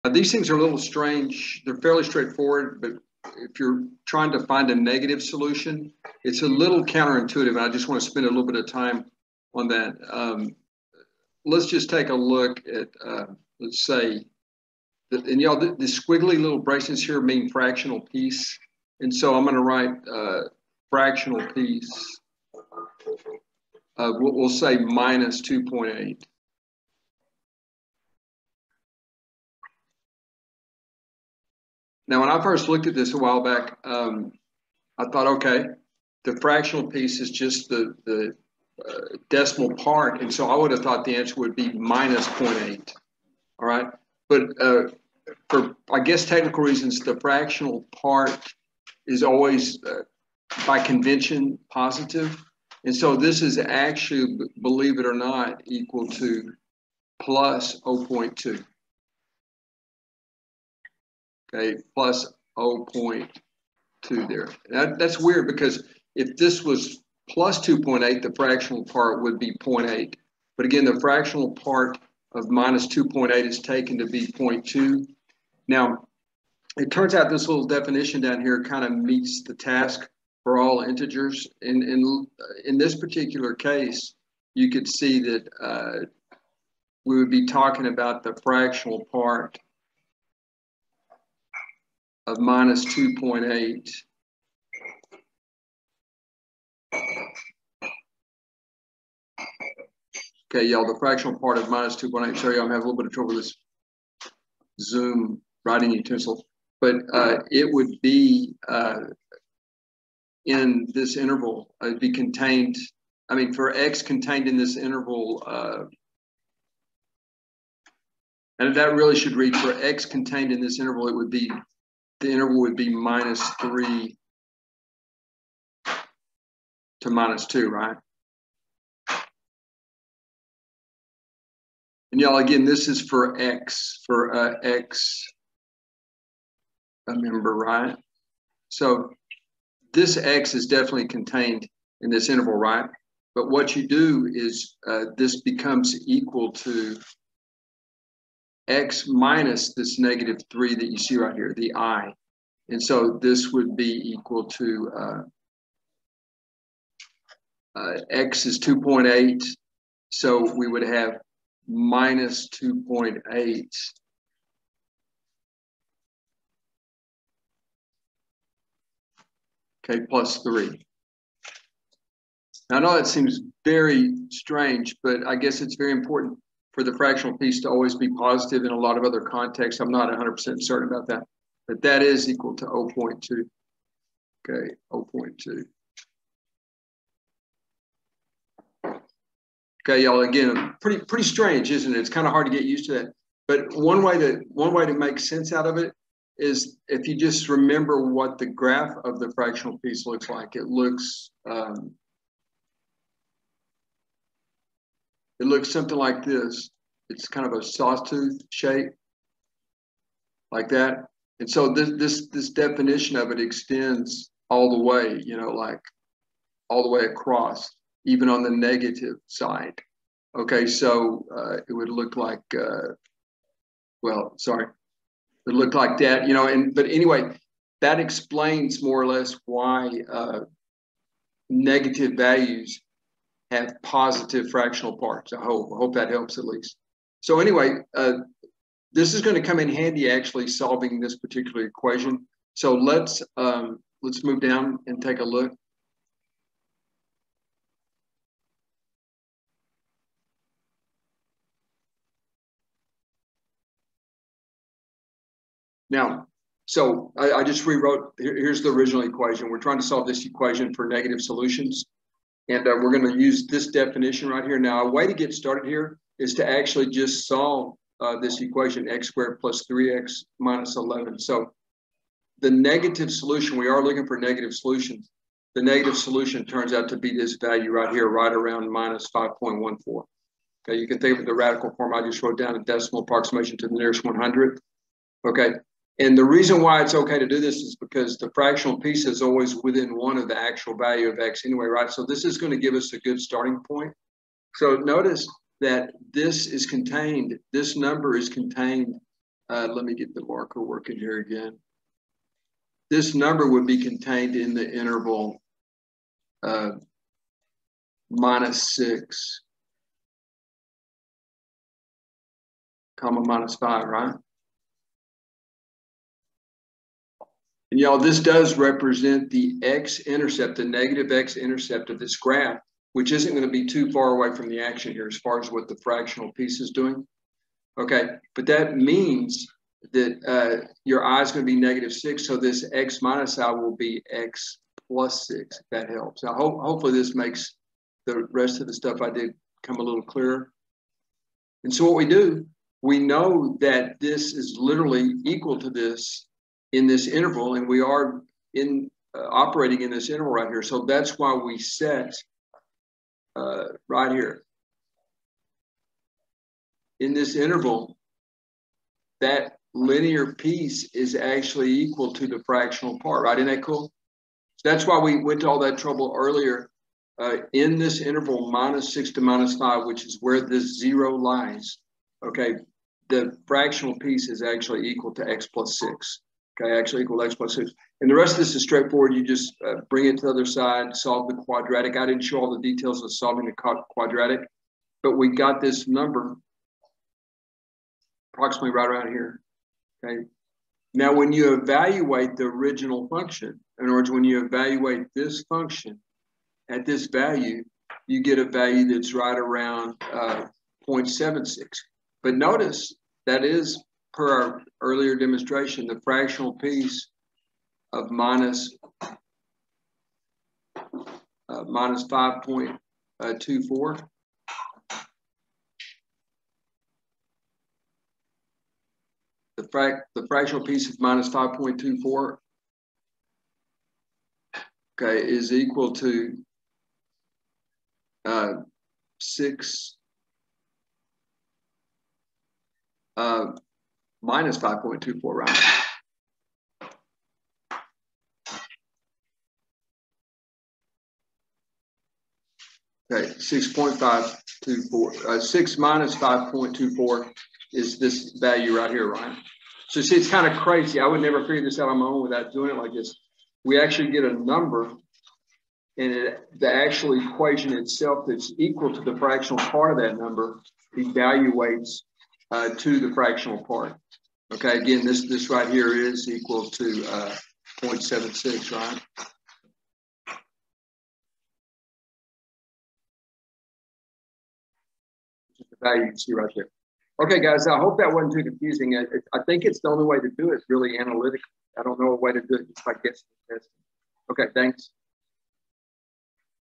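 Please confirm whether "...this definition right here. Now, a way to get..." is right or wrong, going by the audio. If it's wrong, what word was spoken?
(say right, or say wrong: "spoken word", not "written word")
right.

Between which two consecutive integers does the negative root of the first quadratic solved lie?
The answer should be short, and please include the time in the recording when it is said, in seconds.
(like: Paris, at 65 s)
-6 to -5, at 308 s.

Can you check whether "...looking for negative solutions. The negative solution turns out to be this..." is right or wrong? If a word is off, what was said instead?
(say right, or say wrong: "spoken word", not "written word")
right.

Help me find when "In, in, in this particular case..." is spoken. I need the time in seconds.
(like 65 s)
81 s.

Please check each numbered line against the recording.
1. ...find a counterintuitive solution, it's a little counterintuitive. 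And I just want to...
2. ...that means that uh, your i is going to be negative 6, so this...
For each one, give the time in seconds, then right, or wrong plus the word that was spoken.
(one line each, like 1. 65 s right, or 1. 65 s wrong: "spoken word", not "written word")
1. 4 s wrong: "negative", not "counterintuitive"
2. 328 s right.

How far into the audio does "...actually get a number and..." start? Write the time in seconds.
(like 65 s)
453 s.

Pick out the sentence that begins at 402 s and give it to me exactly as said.
But notice that is per our earlier demonstration, the fractional piece of minus, uh, minus 5.24.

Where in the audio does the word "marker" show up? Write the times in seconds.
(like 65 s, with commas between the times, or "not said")
300 s.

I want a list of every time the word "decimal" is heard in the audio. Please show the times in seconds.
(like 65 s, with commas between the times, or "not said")
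39 s, 282 s.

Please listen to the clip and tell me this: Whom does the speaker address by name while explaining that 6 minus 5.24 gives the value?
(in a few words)
Ryan.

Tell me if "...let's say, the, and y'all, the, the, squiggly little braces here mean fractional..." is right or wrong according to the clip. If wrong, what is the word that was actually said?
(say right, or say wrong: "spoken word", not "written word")
right.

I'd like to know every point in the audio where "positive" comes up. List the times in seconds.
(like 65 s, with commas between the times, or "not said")
51 s, 178 s, 233 s.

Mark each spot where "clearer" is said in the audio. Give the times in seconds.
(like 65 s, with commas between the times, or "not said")
340 s.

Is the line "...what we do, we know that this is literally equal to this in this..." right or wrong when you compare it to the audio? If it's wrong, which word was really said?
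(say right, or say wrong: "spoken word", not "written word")
right.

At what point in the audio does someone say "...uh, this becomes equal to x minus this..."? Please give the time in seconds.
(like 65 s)
144 s.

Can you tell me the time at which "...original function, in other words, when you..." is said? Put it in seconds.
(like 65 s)
392 s.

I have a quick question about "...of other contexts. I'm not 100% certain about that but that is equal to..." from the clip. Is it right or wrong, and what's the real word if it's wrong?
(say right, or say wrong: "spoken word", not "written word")
right.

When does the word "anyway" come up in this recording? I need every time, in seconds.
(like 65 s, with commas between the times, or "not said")
226 s, 237 s, 291 s.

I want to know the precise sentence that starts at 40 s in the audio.
And so I would have thought the answer would be minus 0.8.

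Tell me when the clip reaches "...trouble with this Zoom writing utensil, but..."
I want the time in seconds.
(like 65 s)
103 s.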